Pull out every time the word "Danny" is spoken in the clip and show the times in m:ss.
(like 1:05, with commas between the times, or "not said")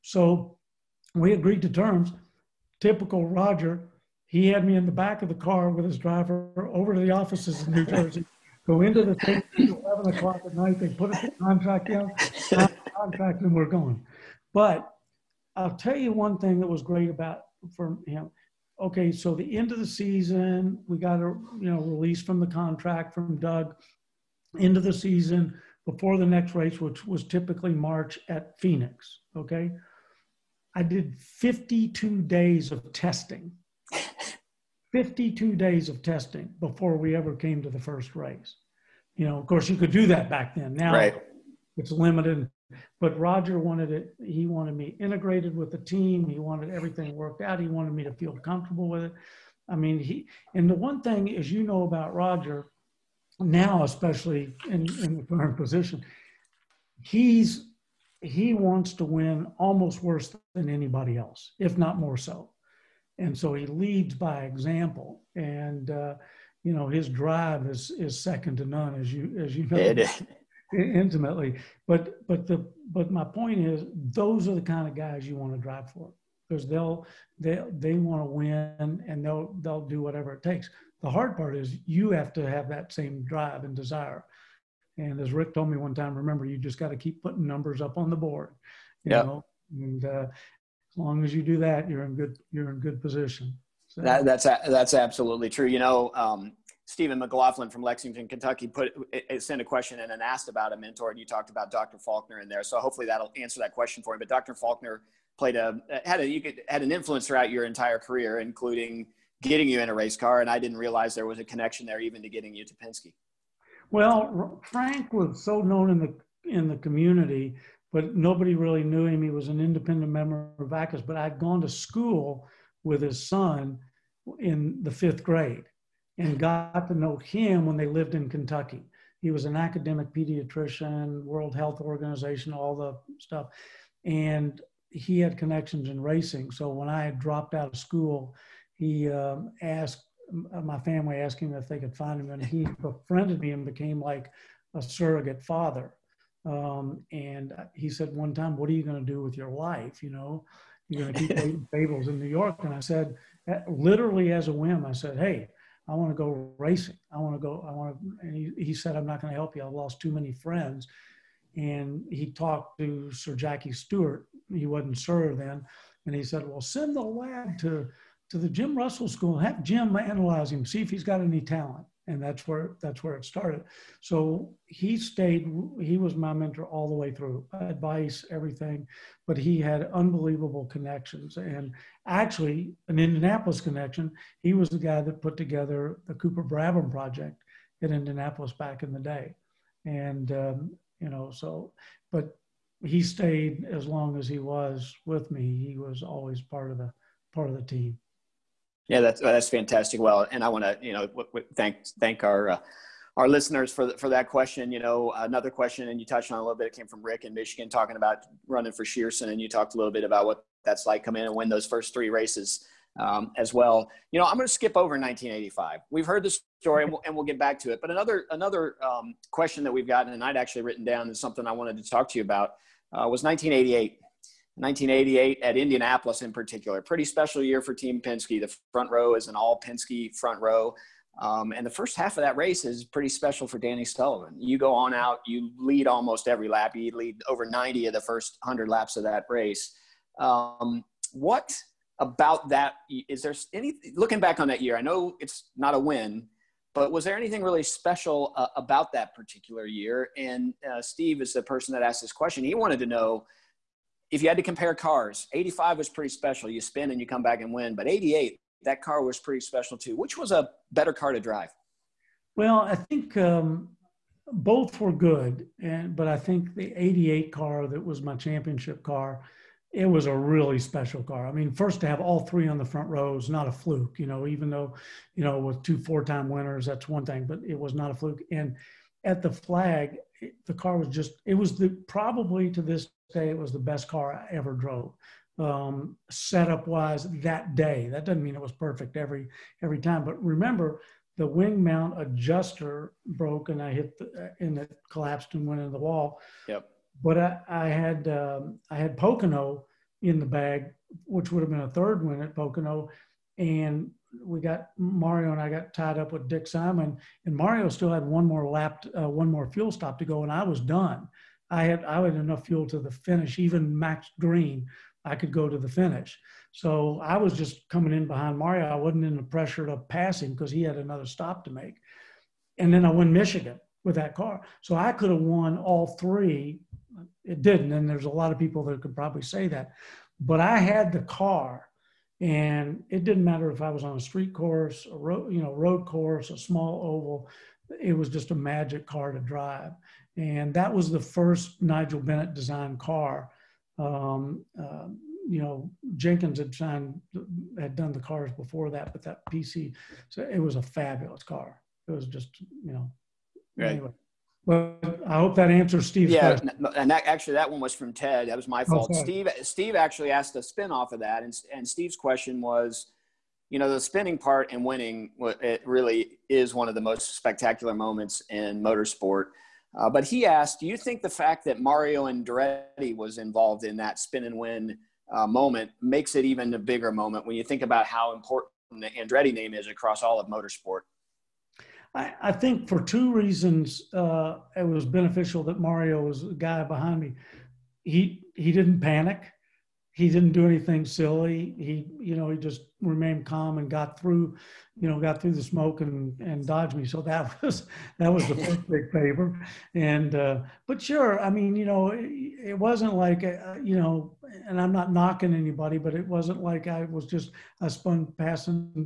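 3:53.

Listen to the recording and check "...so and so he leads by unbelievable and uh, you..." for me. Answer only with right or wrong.
wrong.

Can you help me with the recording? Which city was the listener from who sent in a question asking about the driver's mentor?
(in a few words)
Lexington, Kentucky.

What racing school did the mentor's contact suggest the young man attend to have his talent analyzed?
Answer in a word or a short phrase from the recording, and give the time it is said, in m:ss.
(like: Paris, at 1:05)
Jim Russell School, at 2:48.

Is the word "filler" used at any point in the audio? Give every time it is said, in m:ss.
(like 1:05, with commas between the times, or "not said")
not said.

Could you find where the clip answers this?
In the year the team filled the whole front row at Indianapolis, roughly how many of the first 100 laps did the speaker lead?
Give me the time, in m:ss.
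3:57.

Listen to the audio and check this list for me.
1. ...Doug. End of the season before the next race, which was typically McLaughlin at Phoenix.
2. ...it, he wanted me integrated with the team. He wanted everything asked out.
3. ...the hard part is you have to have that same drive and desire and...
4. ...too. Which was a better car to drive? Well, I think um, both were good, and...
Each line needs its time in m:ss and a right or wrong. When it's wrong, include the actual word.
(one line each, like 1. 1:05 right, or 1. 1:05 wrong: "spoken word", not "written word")
1. 0:23 wrong: "March", not "McLaughlin"
2. 0:43 wrong: "worked", not "asked"
3. 1:21 right
4. 4:19 right.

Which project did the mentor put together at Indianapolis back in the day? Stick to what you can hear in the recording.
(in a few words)
Cooper Brabham.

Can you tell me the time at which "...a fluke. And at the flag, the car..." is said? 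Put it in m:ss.
4:37.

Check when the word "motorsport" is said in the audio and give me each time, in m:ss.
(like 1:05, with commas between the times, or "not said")
6:08, 6:20.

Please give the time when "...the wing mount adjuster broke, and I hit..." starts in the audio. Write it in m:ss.
4:51.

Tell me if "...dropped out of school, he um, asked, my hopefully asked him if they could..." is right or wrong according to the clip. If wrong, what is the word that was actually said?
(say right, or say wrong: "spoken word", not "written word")
wrong: "family", not "hopefully".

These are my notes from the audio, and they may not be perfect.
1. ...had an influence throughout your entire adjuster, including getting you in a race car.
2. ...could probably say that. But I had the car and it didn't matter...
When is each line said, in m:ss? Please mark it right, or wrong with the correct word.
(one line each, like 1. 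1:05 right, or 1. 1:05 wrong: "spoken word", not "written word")
1. 1:46 wrong: "career", not "adjuster"
2. 5:28 right.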